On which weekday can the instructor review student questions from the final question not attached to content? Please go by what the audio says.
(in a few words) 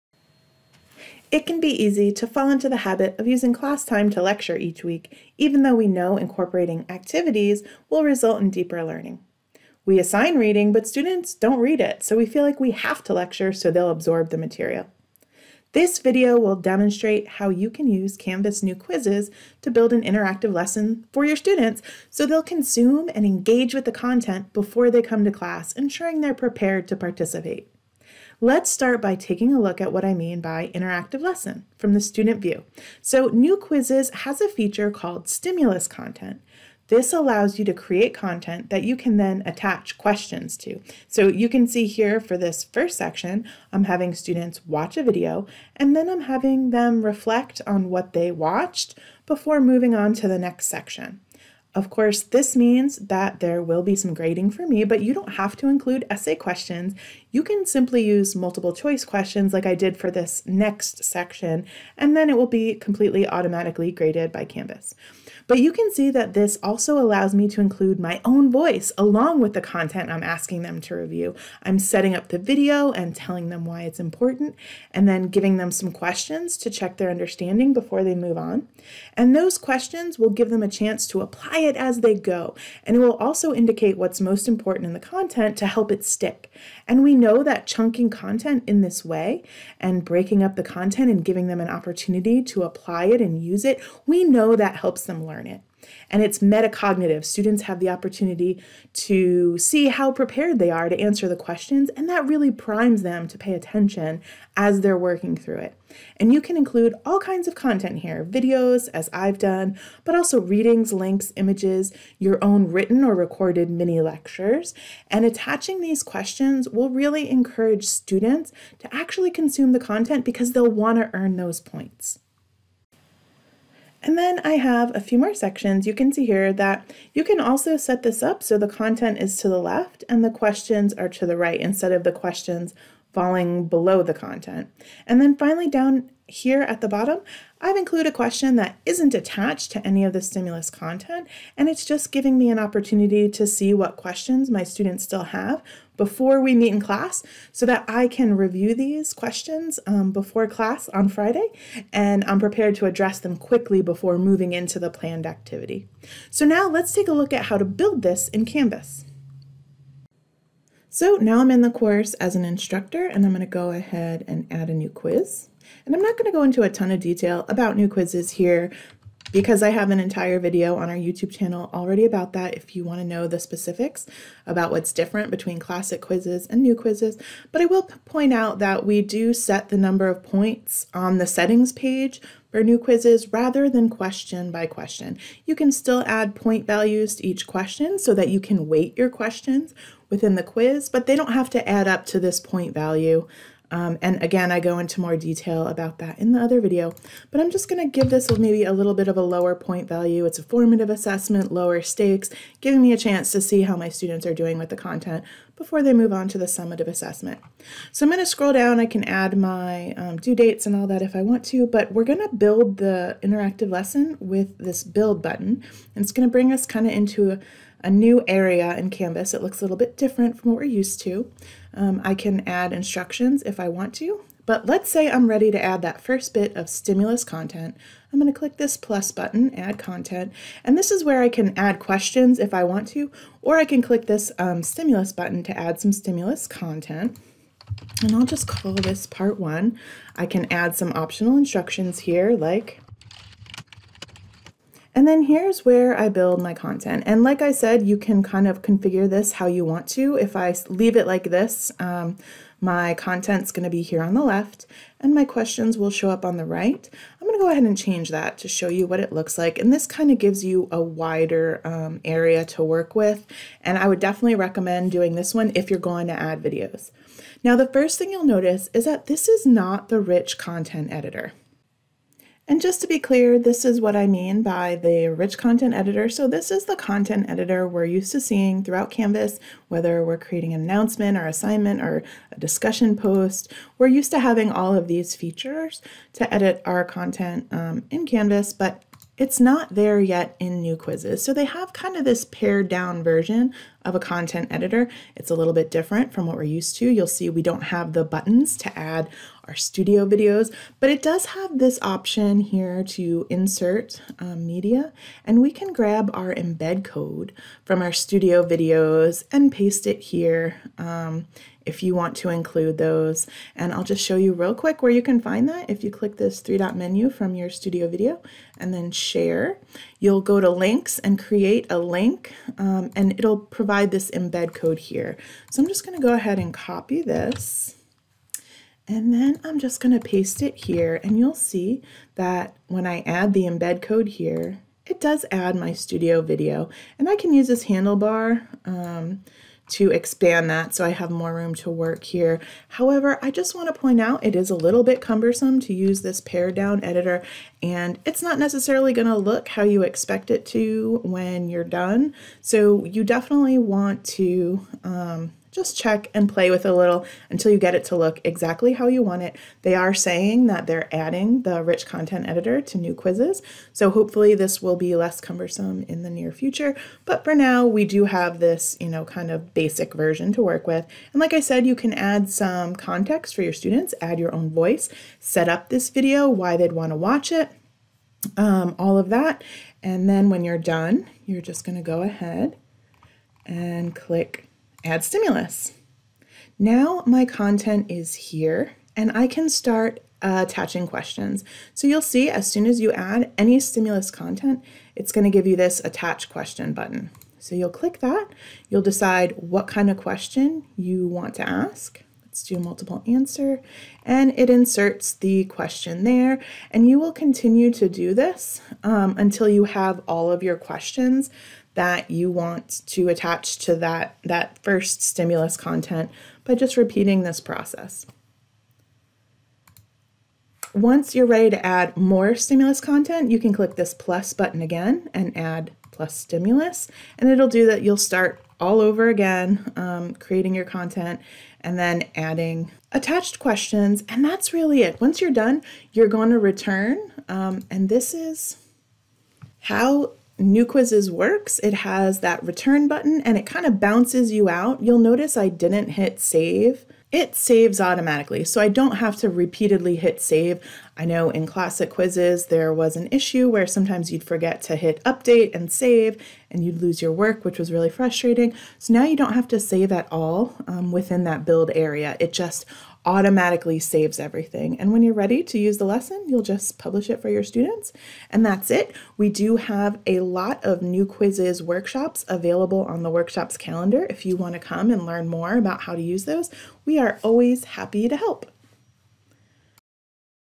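Friday.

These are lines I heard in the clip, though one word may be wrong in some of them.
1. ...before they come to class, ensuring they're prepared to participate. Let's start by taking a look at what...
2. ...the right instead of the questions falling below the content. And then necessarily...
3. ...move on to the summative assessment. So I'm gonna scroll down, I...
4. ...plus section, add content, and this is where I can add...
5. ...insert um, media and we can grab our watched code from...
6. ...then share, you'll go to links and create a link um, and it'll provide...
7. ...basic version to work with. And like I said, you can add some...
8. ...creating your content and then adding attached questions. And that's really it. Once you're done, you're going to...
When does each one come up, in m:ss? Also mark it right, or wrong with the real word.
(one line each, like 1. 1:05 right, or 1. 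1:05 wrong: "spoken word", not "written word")
1. 0:24 right
2. 2:11 wrong: "finally", not "necessarily"
3. 3:25 right
4. 3:48 wrong: "button", not "section"
5. 5:03 wrong: "embed", not "watched"
6. 5:18 right
7. 6:09 right
8. 7:10 right.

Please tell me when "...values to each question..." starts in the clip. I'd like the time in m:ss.
3:06.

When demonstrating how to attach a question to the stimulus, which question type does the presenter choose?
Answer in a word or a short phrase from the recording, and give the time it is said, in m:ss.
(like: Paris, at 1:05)
multiple answer, at 6:42.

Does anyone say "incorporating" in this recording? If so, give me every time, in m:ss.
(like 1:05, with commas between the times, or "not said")
0:06.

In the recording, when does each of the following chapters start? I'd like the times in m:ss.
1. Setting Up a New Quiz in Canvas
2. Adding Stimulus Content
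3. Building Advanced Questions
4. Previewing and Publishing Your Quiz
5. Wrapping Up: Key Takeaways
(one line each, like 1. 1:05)
1. 1:10
2. 3:00
3. 4:30
4. 6:00
5. 7:30.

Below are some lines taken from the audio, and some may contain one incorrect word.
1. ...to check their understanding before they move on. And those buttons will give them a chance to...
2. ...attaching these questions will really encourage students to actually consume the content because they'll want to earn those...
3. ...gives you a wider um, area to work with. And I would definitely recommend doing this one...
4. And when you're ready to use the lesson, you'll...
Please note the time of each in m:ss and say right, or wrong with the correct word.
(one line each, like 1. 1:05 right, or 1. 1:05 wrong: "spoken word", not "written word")
1. 1:16 wrong: "questions", not "buttons"
2. 1:55 right
3. 4:20 right
4. 7:44 right.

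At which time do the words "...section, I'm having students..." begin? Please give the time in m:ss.
0:42.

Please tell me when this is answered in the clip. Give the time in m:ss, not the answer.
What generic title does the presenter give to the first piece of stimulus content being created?
3:59.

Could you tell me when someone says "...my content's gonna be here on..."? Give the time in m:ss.
4:12.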